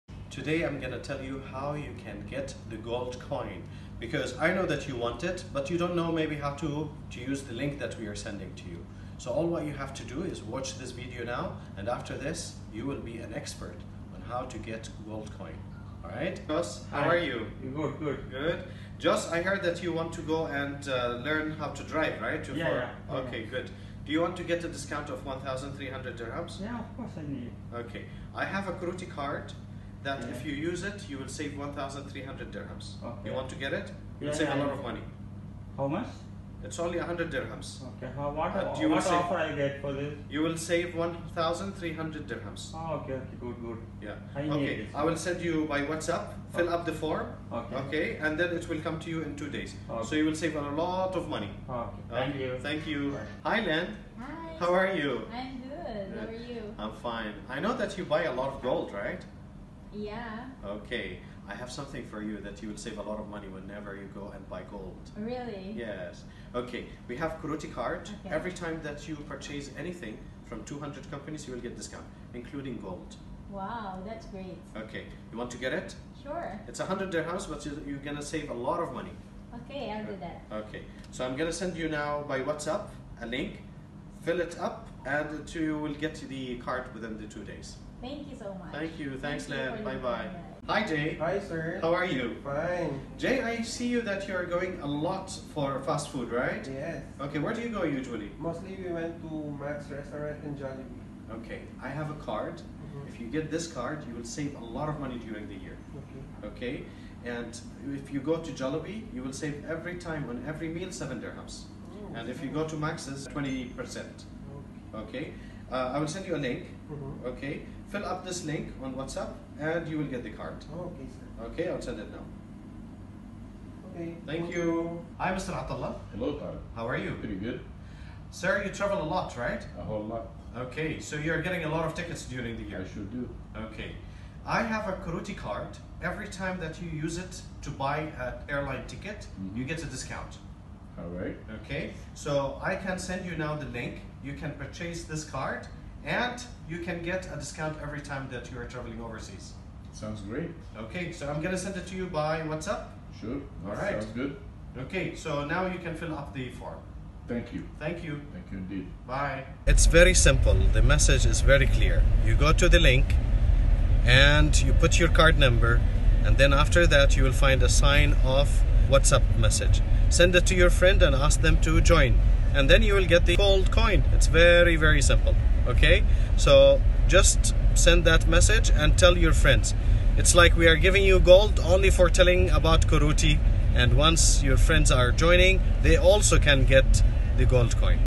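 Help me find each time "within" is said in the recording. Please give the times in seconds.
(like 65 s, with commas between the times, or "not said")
86 s.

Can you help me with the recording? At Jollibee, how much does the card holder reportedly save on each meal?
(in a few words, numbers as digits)
7 dirhams.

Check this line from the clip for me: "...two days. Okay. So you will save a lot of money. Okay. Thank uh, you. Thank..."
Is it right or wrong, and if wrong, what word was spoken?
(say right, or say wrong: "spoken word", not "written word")
right.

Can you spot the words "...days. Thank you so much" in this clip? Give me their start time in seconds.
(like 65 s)
87 s.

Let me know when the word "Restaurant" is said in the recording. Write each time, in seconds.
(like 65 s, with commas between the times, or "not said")
99 s.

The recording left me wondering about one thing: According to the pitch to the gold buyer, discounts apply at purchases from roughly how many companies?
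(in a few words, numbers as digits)
200.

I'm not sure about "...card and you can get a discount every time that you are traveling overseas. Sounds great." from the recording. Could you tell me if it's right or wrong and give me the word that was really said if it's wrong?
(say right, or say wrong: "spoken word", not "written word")
right.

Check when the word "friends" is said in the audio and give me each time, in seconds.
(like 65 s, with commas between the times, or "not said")
170 s, 179 s, 184 s.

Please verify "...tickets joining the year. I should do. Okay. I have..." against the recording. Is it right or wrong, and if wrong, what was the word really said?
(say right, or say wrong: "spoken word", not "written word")
wrong: "during", not "joining".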